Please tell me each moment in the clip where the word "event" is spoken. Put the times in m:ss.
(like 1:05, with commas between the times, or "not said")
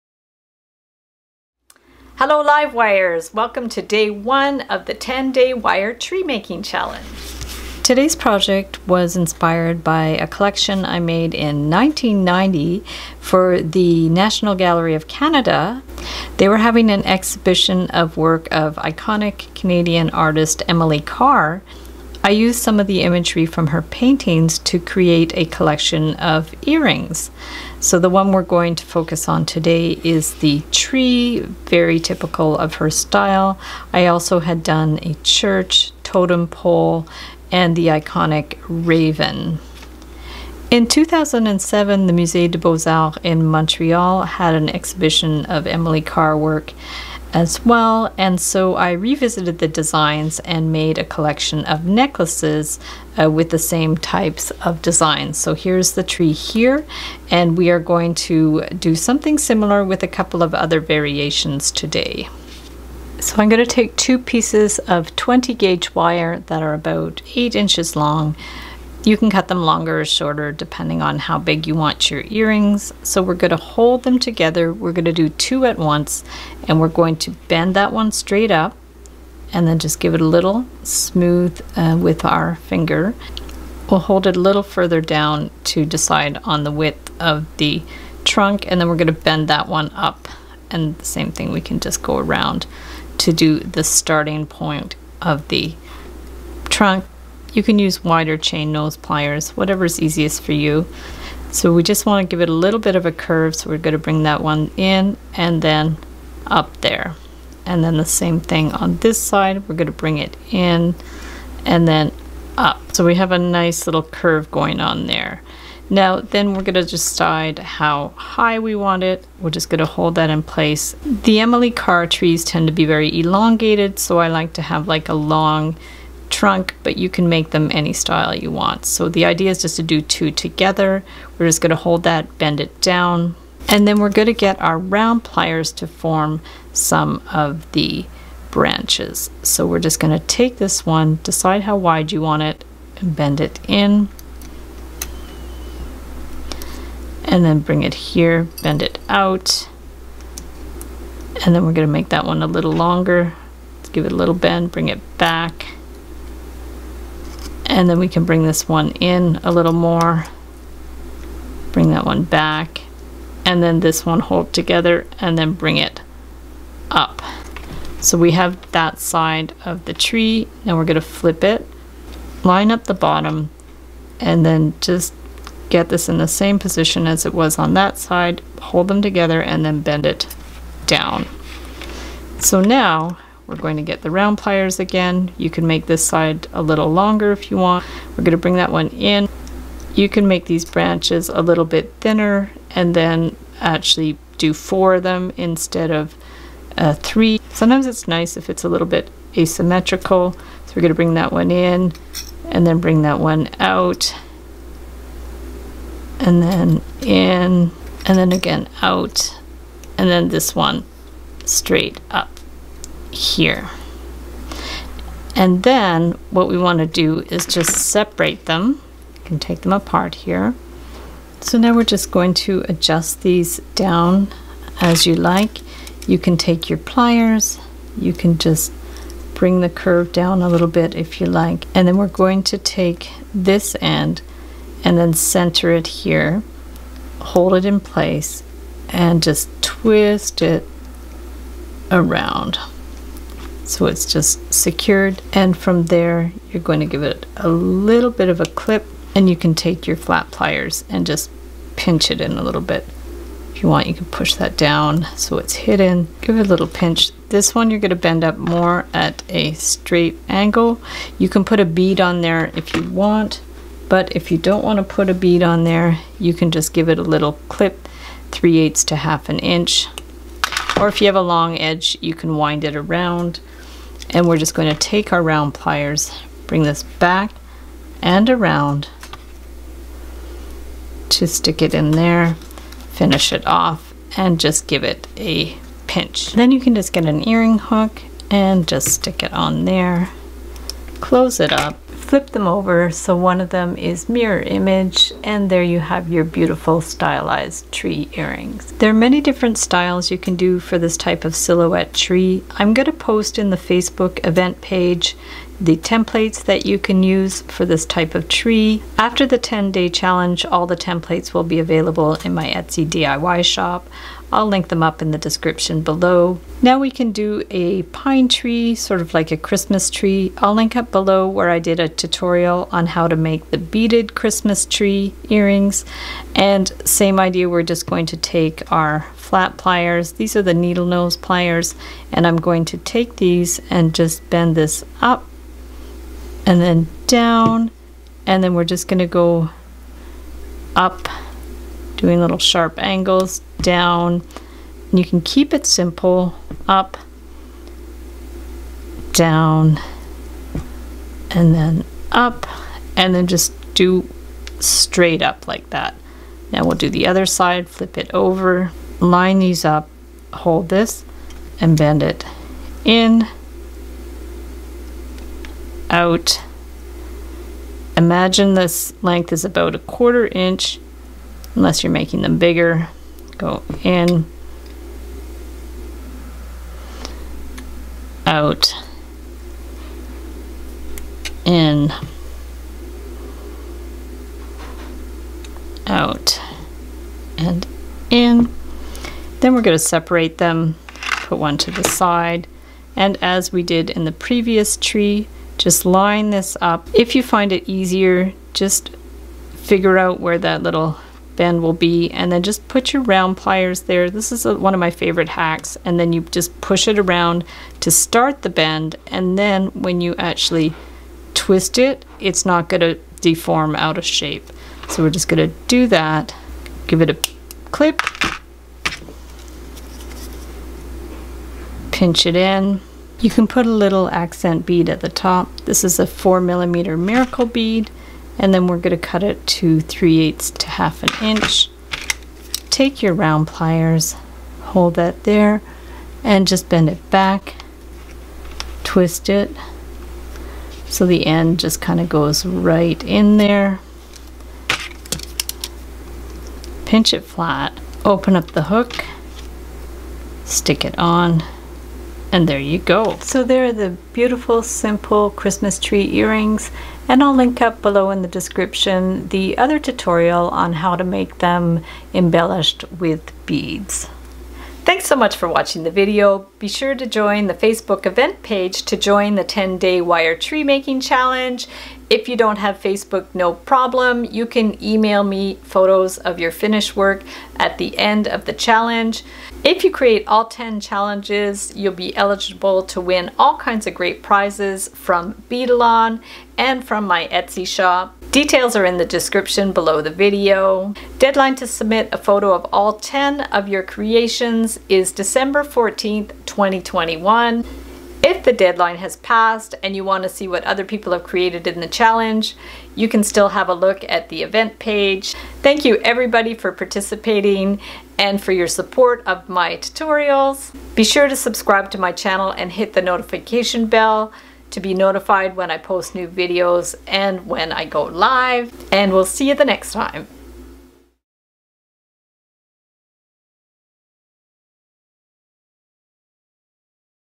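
5:04, 7:48, 8:24.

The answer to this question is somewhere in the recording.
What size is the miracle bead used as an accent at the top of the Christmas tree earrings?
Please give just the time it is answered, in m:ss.
7:06.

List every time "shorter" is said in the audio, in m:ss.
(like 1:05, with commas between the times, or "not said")
1:10.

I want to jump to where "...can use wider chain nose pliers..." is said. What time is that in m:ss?
1:37.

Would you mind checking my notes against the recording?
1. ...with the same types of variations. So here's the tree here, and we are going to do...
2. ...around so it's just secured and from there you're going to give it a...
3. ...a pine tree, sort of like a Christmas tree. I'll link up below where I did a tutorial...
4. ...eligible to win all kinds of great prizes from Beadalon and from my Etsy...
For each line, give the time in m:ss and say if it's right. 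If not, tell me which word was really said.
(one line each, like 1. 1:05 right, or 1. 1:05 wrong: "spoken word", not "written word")
1. 0:53 wrong: "designs", not "variations"
2. 4:01 right
3. 5:17 right
4. 8:02 right.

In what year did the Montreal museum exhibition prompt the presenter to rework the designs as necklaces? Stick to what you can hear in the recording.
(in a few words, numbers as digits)
2007.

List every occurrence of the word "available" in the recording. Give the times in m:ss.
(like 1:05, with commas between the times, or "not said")
5:11.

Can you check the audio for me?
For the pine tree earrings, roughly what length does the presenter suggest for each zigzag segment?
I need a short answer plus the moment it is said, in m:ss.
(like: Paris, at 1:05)
a quarter inch, at 6:09.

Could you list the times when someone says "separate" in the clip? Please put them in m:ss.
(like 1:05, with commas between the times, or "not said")
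3:37, 6:29.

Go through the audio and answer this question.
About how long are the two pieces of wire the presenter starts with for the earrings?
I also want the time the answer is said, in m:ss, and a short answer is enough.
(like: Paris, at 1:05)
8 inches, at 1:07.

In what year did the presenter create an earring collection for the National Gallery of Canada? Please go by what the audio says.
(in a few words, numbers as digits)
1990.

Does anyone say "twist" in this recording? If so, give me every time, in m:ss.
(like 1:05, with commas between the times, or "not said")
3:59, 6:51, 7:18.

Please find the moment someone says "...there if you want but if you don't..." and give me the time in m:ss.
4:22.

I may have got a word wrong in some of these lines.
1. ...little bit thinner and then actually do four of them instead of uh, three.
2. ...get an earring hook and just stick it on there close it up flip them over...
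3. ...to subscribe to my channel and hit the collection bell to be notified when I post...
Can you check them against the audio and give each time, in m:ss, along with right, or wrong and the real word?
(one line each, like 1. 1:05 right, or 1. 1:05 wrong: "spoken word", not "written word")
1. 3:11 right
2. 4:46 right
3. 8:31 wrong: "notification", not "collection".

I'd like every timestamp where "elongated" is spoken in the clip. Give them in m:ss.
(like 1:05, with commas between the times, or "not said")
2:03.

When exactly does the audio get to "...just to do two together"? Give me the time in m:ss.
2:09.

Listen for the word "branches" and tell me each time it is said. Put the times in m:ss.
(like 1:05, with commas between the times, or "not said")
2:18, 3:10.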